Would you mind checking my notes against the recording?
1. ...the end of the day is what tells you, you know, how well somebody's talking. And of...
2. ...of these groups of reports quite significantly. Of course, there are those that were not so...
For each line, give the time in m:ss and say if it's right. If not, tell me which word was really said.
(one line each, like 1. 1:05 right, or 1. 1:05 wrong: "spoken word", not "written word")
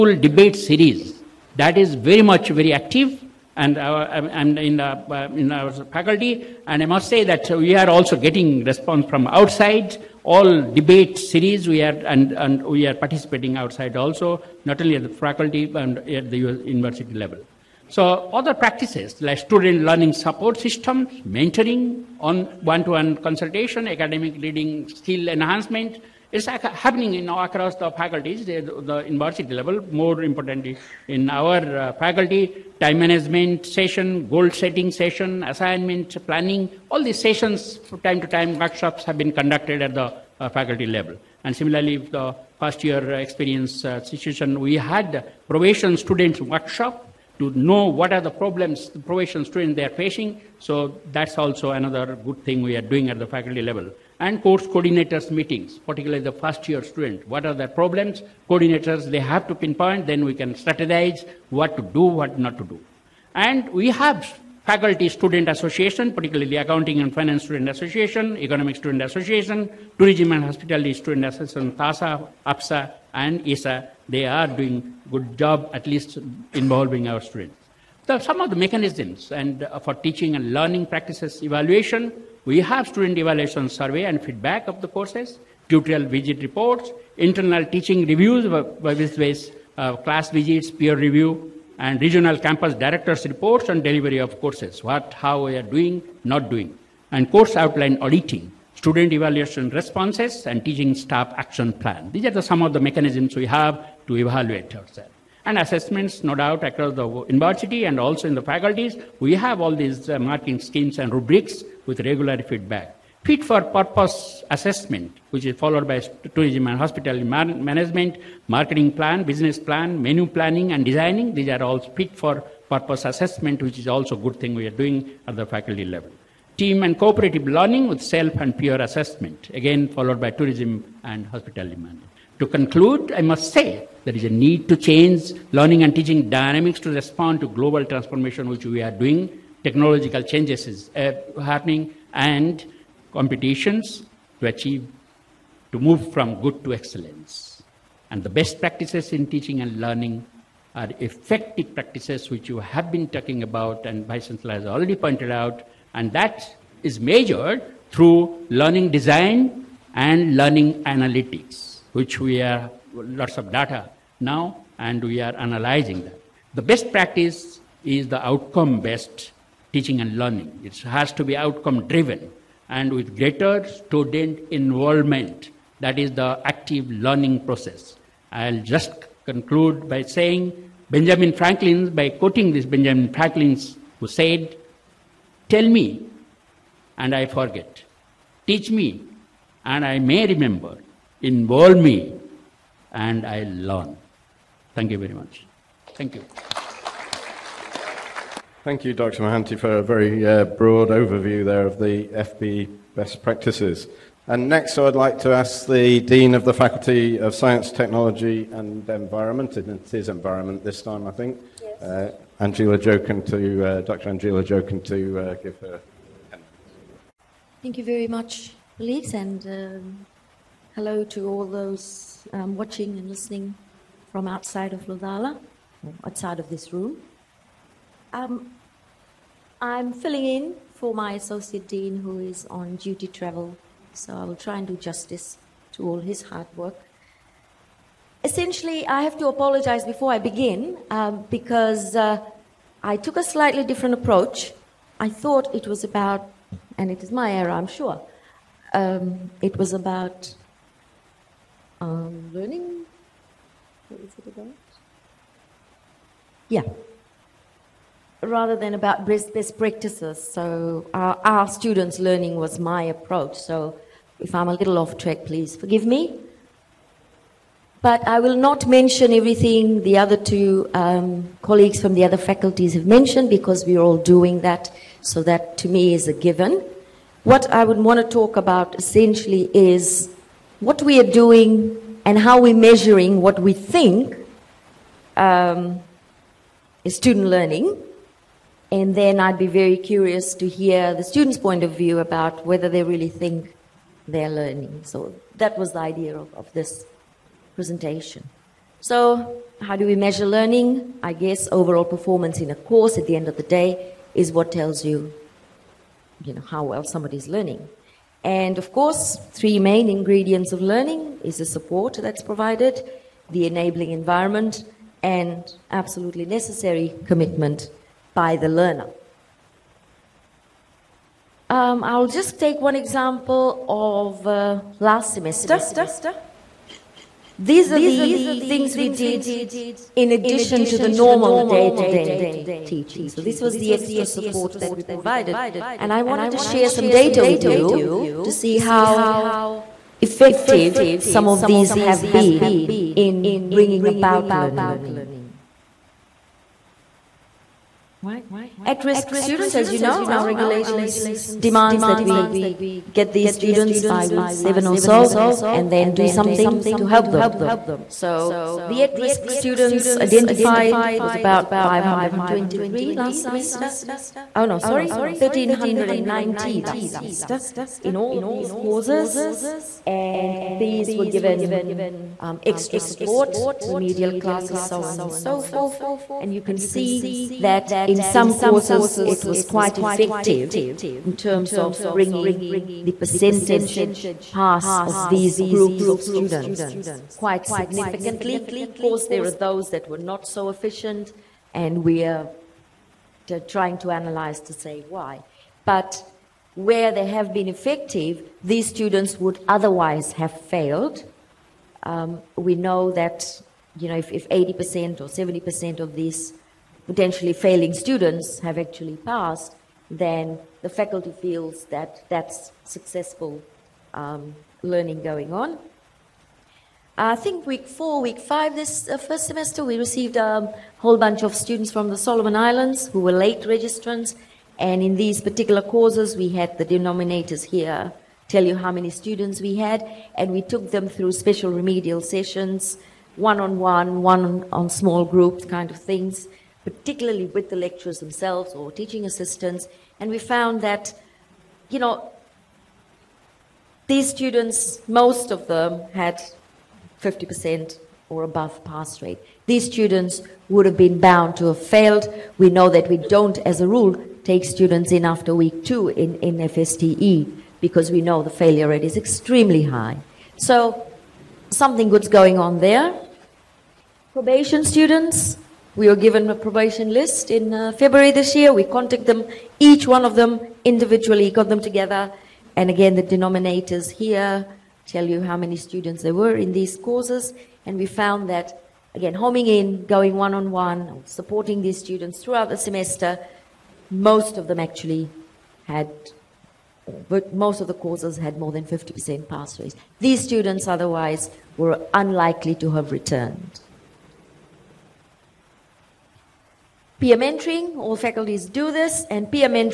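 1. 5:03 wrong: "learning", not "talking"
2. 6:24 wrong: "students", not "reports".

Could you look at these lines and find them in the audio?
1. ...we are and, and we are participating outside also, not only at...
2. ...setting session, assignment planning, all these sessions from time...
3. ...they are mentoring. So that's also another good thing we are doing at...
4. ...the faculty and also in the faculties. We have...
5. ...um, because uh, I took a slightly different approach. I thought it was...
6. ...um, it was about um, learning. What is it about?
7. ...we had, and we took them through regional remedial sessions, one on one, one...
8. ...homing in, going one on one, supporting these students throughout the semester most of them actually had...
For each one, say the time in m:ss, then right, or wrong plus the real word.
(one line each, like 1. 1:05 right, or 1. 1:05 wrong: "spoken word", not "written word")
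1. 0:11 right
2. 0:34 right
3. 0:49 wrong: "facing", not "mentoring"
4. 1:46 wrong: "university", not "faculty"
5. 4:00 right
6. 4:08 right
7. 7:09 wrong: "special", not "regional"
8. 7:59 right.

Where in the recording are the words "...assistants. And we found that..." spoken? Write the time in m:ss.
7:19.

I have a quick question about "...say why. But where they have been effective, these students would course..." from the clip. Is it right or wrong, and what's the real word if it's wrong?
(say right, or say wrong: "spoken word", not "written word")
wrong: "otherwise", not "course".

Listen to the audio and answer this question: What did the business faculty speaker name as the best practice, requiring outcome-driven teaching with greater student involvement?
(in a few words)
Outcome based teaching and learning.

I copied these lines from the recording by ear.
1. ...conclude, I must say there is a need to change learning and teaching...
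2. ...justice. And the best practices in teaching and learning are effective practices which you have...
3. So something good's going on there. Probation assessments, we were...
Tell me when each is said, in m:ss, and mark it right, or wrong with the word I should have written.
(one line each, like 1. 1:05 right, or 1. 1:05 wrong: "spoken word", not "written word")
1. 2:12 right
2. 2:26 wrong: "excellence", not "justice"
3. 7:40 wrong: "students", not "assessments".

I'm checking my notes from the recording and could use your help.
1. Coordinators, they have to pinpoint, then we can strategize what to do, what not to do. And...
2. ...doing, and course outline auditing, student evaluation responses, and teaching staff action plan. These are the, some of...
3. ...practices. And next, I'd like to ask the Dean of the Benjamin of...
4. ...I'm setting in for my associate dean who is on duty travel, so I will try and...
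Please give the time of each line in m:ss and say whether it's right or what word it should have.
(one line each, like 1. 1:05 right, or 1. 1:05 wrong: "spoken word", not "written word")
1. 0:58 right
2. 1:36 right
3. 3:23 wrong: "Faculty", not "Benjamin"
4. 3:49 wrong: "filling", not "setting".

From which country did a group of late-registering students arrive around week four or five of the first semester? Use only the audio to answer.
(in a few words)
Solomon Islands.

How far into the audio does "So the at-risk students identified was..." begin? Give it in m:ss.
5:57.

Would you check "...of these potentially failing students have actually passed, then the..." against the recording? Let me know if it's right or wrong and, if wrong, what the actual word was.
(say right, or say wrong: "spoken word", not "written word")
right.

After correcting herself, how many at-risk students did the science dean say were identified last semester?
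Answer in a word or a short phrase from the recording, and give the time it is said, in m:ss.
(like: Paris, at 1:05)
1390, at 6:05.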